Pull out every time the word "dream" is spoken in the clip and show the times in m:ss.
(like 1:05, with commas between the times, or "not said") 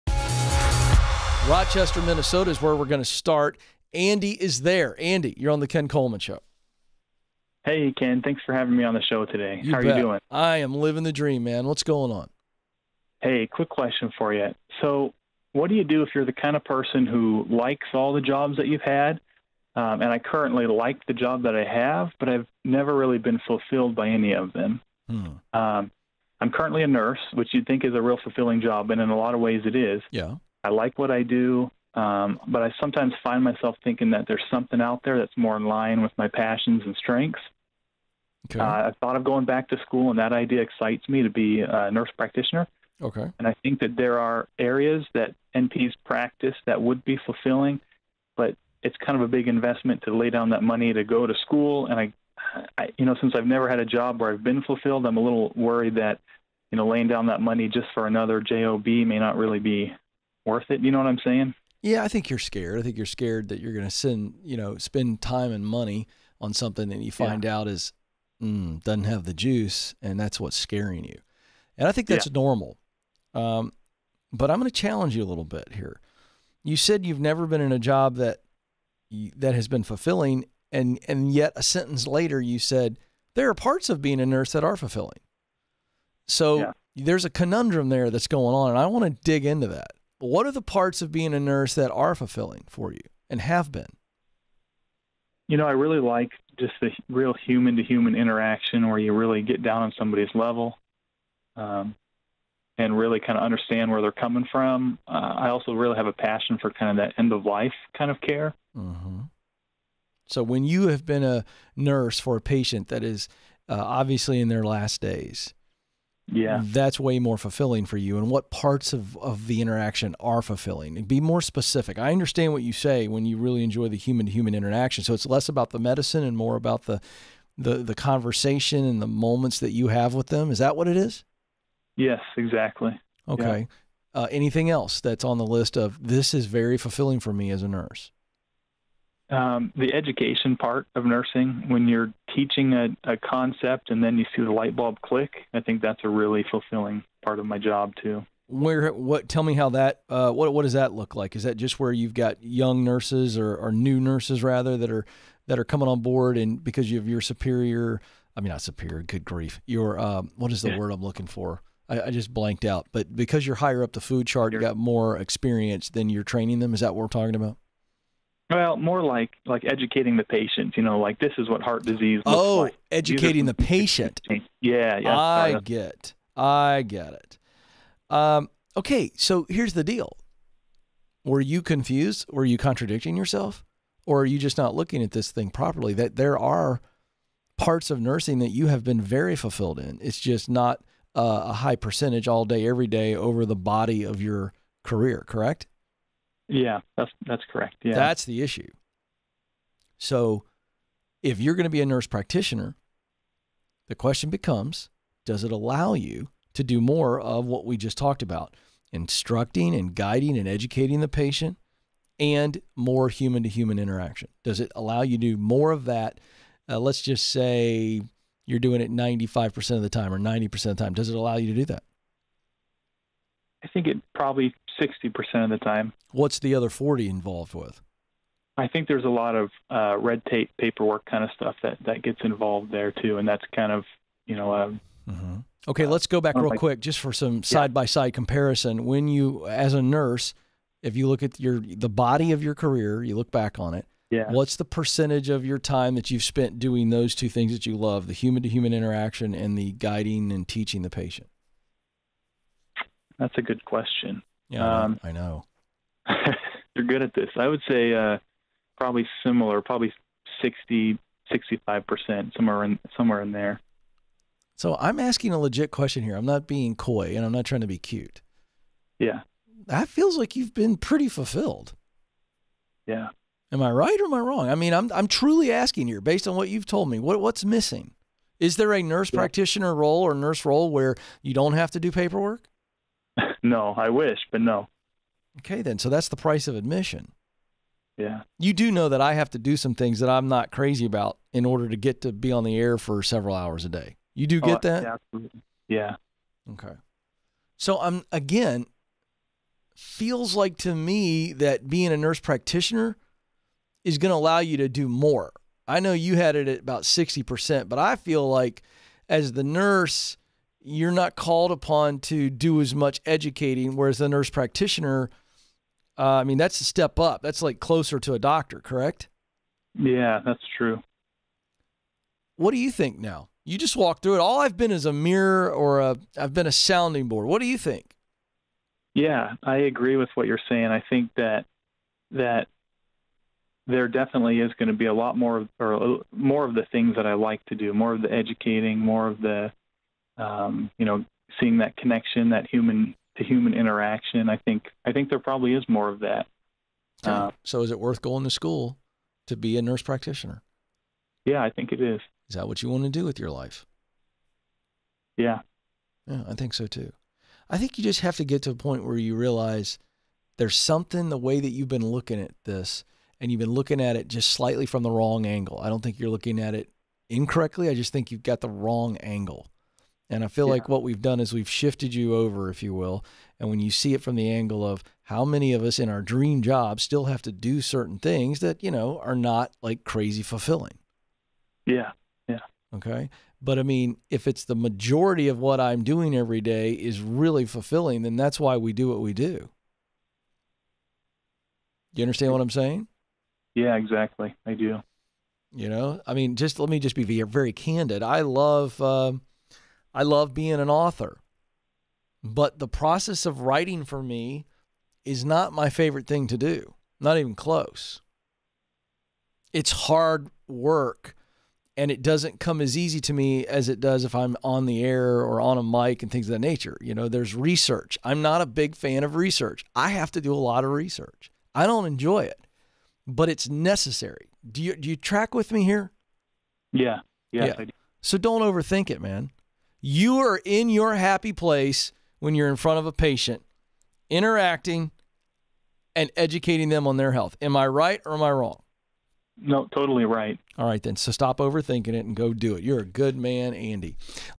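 0:11, 6:16.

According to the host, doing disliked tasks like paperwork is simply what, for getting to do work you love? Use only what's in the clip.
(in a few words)
the price of admission.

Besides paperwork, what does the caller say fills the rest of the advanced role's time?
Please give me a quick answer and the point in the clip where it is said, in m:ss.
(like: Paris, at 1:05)
red tape, at 3:49.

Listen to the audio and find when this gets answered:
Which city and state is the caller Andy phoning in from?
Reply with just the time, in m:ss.
0:01.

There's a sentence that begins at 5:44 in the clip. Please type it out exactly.
I think I think there probably is more of that.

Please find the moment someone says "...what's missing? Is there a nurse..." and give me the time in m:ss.
4:37.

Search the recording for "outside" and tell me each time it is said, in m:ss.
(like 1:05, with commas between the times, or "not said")
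not said.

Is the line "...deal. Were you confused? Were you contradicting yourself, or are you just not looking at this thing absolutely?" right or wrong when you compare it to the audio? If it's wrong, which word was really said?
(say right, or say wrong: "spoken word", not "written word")
wrong: "properly", not "absolutely".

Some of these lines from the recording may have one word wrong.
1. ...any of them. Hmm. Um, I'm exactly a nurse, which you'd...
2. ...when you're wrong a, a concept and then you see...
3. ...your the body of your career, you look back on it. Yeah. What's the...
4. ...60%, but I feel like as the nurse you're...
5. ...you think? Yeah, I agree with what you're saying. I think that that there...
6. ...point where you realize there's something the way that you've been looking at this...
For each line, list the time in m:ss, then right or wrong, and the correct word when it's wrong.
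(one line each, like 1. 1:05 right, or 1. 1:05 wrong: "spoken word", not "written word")
1. 0:24 wrong: "currently", not "exactly"
2. 2:21 wrong: "teaching", not "wrong"
3. 4:01 right
4. 5:06 right
5. 5:27 right
6. 5:58 right.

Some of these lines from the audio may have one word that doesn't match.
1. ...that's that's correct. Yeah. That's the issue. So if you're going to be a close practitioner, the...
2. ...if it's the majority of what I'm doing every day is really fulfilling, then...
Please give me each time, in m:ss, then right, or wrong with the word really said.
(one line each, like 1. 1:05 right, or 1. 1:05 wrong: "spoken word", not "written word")
1. 3:16 wrong: "nurse", not "close"
2. 6:24 right.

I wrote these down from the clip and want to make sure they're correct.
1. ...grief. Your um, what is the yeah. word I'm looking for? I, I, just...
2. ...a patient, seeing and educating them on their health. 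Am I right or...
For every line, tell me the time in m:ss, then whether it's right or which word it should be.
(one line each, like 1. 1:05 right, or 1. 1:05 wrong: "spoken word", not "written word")
1. 2:39 right
2. 7:12 wrong: "interacting", not "seeing".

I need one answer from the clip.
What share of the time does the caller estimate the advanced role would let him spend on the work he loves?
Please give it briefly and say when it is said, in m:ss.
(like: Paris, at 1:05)
60%, at 3:44.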